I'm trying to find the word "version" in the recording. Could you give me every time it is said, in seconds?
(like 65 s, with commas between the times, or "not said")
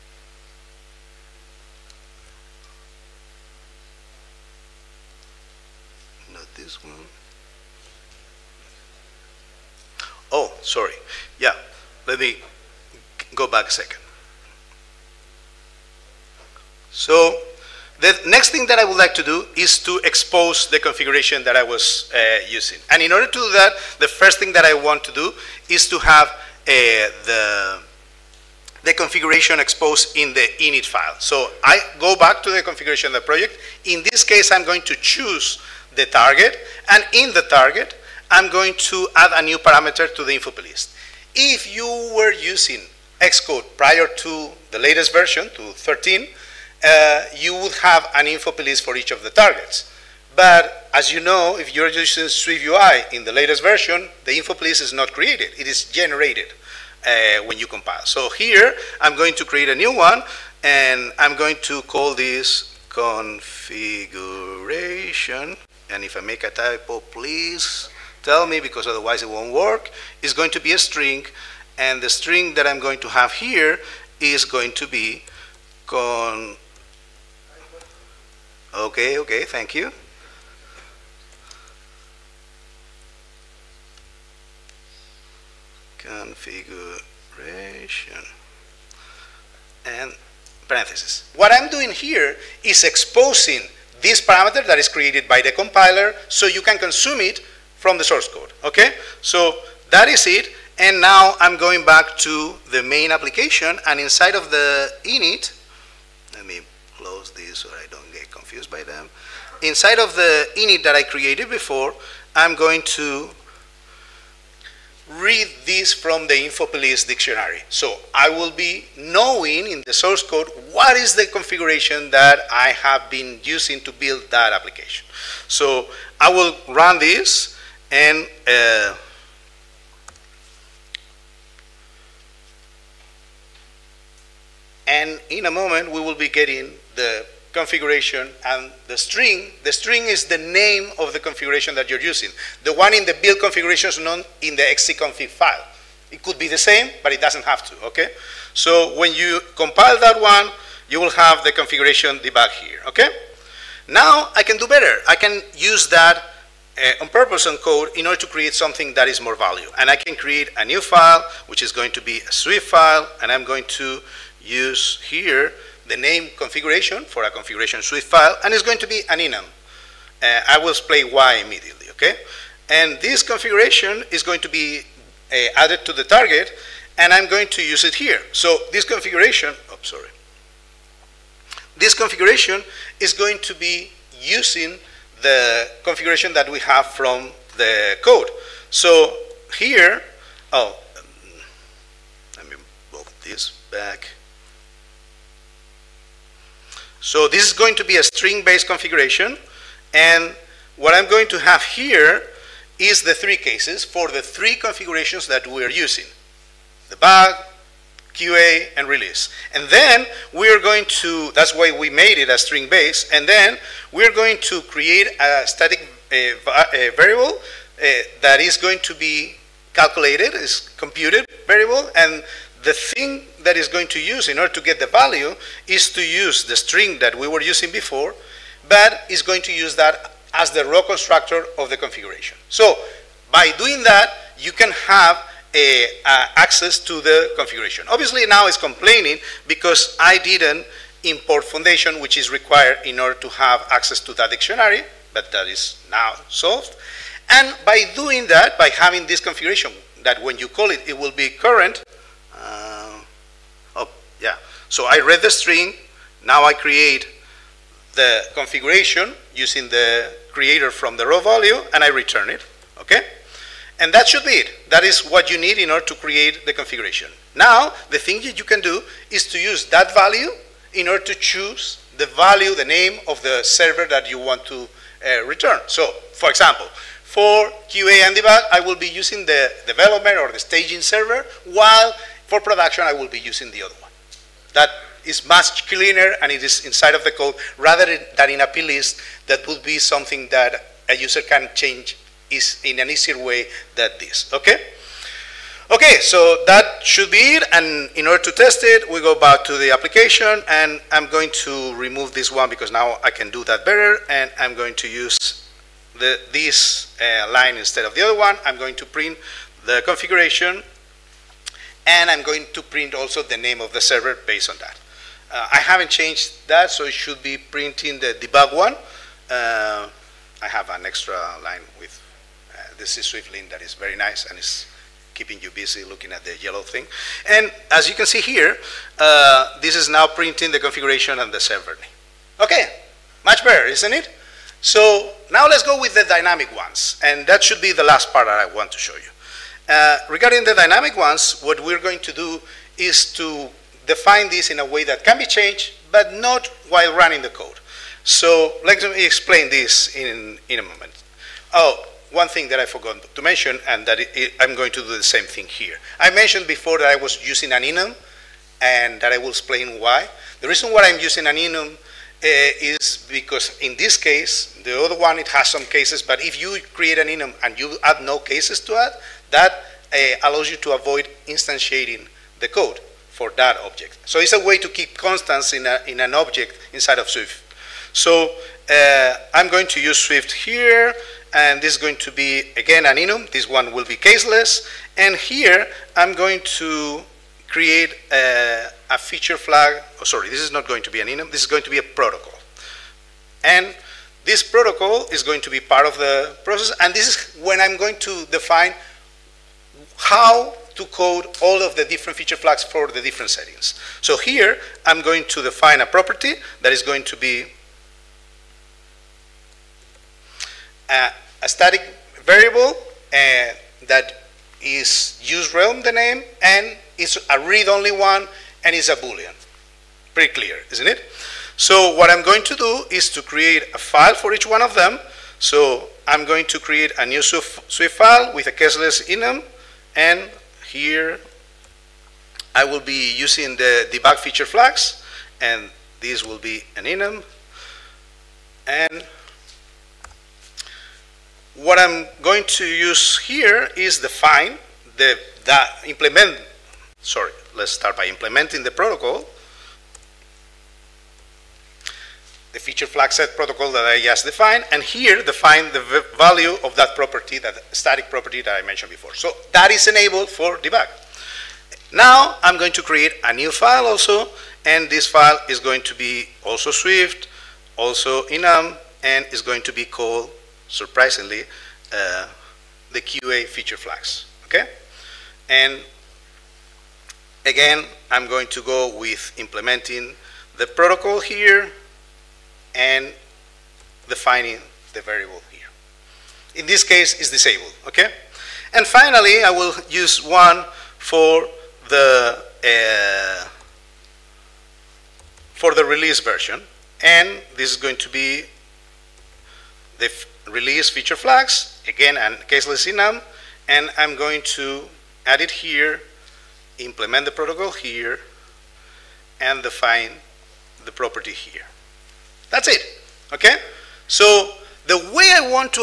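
45 s, 53 s, 496 s.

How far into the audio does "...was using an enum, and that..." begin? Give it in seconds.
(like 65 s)
356 s.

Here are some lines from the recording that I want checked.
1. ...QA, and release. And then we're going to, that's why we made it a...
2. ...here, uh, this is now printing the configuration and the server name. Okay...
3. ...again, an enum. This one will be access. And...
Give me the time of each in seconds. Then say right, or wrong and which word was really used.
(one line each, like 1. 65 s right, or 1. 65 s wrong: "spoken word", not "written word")
1. 208 s right
2. 328 s right
3. 382 s wrong: "caseless", not "access".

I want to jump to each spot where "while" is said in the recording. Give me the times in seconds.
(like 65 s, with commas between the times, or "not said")
281 s, 346 s.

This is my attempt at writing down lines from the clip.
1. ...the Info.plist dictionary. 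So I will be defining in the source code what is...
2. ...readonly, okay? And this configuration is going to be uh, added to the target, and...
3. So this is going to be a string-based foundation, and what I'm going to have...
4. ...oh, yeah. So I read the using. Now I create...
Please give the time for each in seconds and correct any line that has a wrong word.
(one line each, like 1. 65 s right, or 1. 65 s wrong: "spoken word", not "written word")
1. 116 s wrong: "knowing", not "defining"
2. 171 s wrong: "immediately", not "readonly"
3. 197 s wrong: "configuration", not "foundation"
4. 253 s wrong: "string", not "using".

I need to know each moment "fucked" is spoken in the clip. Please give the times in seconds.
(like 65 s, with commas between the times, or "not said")
not said.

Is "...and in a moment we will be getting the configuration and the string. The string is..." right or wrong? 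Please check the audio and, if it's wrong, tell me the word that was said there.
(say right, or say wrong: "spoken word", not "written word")
right.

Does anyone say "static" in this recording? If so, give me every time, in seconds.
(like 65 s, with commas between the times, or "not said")
215 s, 411 s, 457 s.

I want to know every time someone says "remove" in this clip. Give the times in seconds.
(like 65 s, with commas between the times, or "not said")
301 s.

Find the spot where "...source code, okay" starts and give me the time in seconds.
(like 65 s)
98 s.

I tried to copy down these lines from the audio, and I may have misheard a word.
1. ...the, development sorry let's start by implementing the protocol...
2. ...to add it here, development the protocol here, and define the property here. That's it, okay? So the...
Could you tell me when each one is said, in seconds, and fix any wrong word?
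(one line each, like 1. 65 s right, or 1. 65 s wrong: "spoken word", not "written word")
1. 444 s wrong: "implement", not "development"
2. 504 s wrong: "implement", not "development".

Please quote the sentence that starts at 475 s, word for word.
And again, I'm going to go with implementing the protocol here, and defining the variable here.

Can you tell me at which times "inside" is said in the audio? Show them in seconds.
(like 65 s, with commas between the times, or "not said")
103 s, 109 s, 286 s, 376 s.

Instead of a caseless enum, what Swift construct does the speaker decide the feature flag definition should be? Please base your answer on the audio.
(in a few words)
a protocol.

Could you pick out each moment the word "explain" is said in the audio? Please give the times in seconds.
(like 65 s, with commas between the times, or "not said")
170 s, 349 s, 359 s.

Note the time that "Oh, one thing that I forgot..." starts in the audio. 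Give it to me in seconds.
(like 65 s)
351 s.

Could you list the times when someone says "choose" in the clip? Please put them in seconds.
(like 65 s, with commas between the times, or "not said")
34 s, 271 s.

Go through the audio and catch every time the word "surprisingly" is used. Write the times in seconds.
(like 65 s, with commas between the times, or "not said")
470 s.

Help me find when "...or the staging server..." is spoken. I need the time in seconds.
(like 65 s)
280 s.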